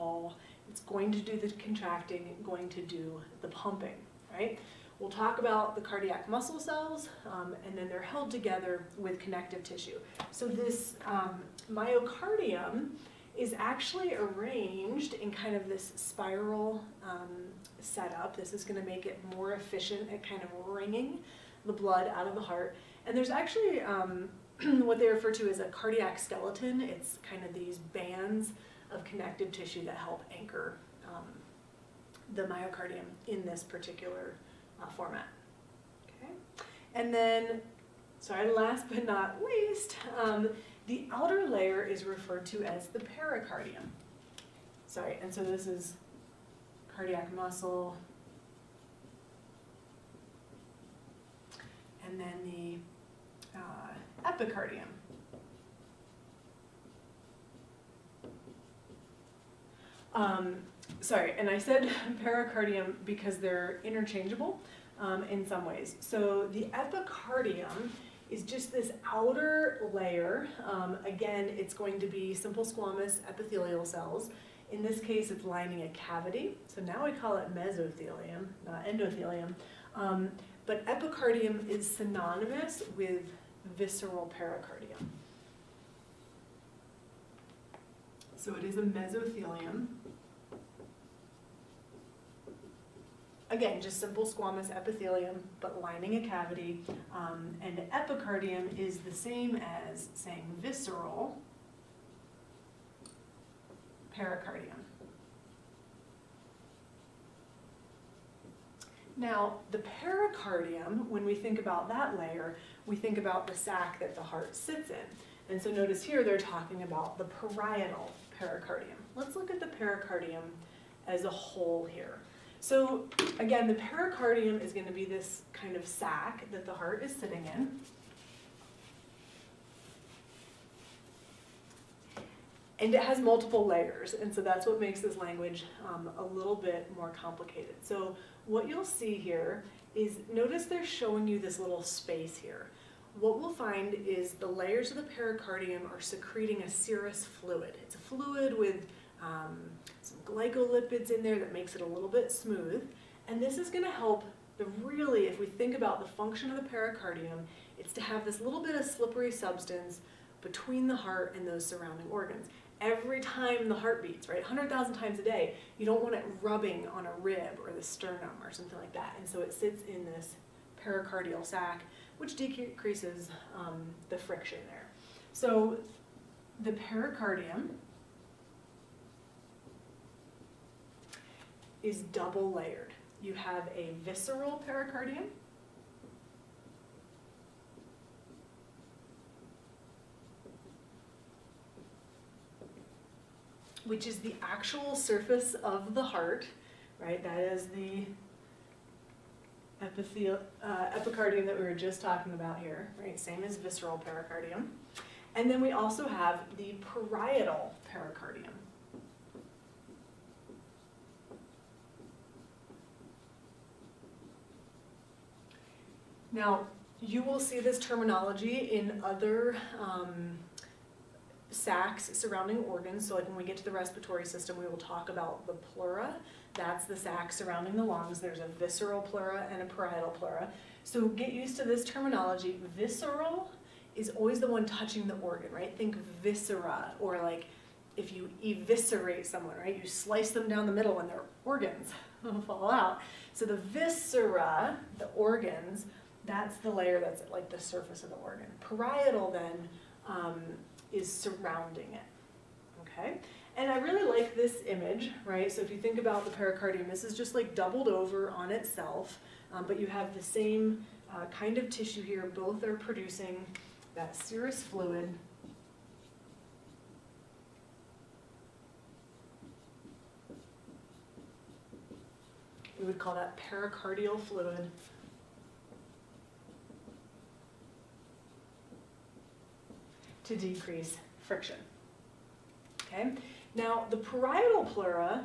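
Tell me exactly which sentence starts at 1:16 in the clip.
So now we call it mesothelium, not endothelium.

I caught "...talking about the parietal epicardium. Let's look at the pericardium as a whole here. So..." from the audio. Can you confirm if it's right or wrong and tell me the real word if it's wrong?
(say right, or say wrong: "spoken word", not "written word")
wrong: "pericardium", not "epicardium".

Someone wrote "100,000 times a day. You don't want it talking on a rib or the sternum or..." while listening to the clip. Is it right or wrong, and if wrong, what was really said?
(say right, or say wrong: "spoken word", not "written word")
wrong: "rubbing", not "talking".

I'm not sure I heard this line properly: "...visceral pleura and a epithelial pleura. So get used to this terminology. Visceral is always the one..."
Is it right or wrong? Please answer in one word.
wrong.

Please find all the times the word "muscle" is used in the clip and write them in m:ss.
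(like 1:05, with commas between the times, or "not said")
0:06, 0:47.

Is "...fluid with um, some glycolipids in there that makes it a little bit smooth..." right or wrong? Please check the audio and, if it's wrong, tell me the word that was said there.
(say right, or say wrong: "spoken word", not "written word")
right.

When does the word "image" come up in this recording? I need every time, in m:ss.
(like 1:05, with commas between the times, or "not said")
4:14.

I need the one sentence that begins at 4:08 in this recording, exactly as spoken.
Parietal then um, is surrounding it.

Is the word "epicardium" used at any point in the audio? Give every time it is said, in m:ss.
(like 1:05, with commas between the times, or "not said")
0:54, 1:06, 1:20, 1:37, 3:20.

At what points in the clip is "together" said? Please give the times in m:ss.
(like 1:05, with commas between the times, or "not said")
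0:08.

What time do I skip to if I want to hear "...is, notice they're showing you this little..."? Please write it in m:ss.
2:19.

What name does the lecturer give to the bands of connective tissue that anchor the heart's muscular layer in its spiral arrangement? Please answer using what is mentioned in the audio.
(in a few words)
cardiac skeleton.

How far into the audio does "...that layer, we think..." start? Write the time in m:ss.
1:51.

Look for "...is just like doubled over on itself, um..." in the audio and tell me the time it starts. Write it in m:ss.
4:17.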